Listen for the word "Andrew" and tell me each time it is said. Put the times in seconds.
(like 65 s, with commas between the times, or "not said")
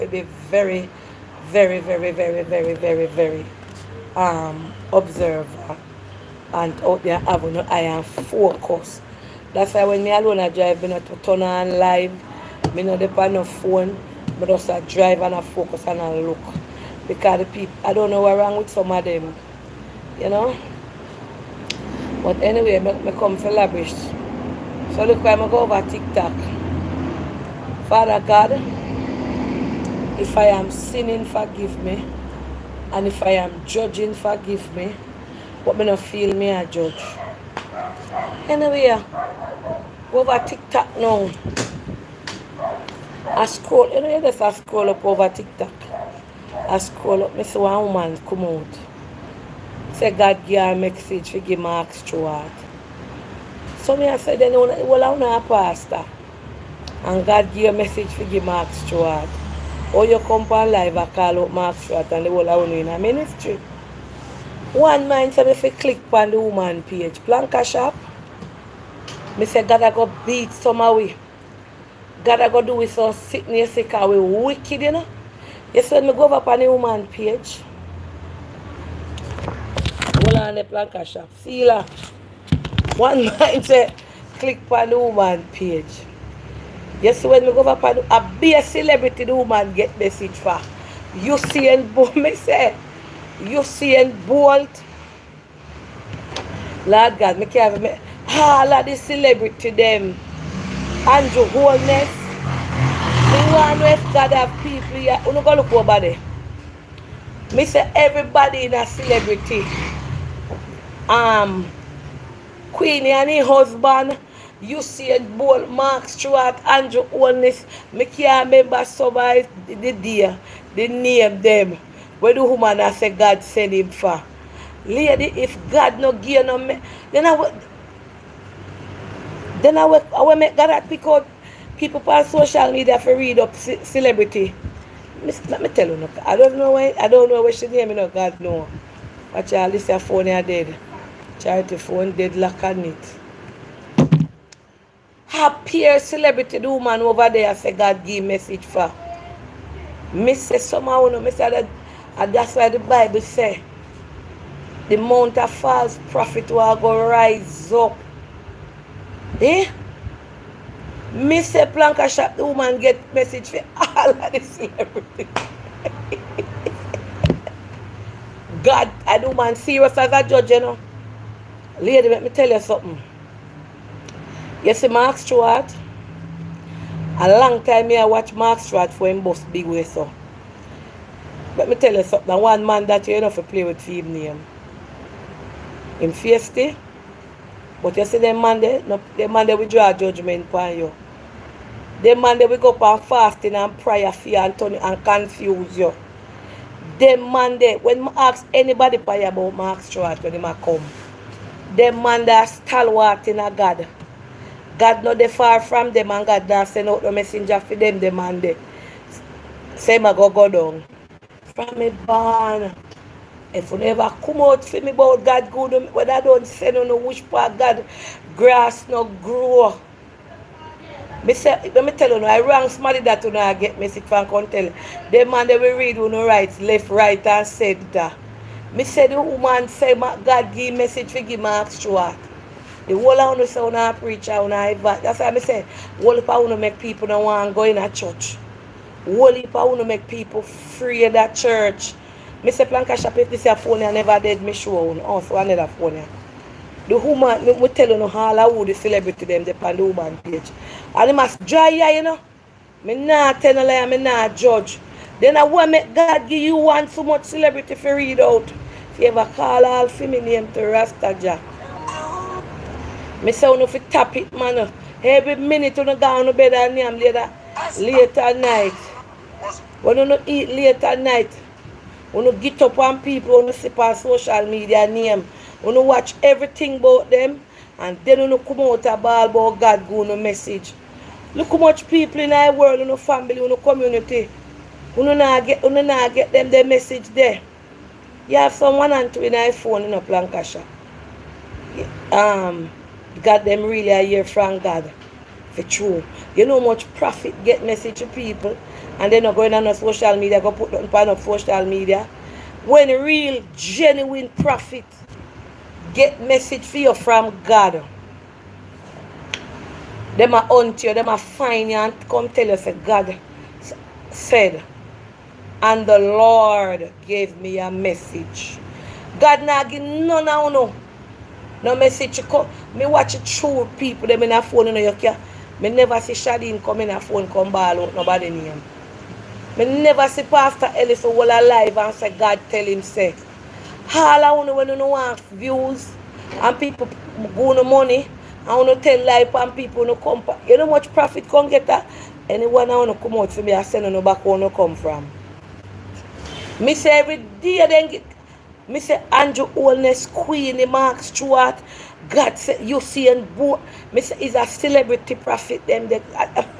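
101 s, 116 s, 349 s.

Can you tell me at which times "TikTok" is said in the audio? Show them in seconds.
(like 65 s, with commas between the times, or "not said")
25 s, 40 s, 45 s.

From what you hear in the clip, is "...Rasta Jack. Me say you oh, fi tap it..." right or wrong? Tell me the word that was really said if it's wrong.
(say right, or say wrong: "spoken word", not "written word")
right.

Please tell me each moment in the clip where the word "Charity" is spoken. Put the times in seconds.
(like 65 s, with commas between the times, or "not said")
141 s.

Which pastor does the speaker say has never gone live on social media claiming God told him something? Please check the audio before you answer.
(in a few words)
Pastor Ellis.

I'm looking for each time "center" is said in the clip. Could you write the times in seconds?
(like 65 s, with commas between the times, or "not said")
227 s.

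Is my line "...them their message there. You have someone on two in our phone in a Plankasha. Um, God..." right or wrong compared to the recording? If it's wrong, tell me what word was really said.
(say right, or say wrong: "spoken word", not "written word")
right.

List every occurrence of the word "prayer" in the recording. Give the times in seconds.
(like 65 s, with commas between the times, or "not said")
193 s, 198 s.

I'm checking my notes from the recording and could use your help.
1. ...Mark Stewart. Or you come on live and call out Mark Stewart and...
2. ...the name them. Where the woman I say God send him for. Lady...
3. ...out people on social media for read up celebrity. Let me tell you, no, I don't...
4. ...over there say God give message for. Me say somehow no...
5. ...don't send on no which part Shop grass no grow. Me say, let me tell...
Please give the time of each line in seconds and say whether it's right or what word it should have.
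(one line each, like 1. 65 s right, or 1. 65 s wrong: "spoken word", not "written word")
1. 58 s right
2. 120 s right
3. 131 s right
4. 147 s right
5. 216 s wrong: "God", not "Shop".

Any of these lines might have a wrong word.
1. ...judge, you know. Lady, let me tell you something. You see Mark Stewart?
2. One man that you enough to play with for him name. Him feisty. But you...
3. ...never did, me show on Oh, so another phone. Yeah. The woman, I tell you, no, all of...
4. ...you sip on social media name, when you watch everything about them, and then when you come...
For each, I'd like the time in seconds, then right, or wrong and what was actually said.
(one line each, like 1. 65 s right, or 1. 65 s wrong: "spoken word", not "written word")
1. 170 s right
2. 182 s right
3. 243 s right
4. 273 s right.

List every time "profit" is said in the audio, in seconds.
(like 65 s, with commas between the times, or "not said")
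296 s, 304 s, 340 s.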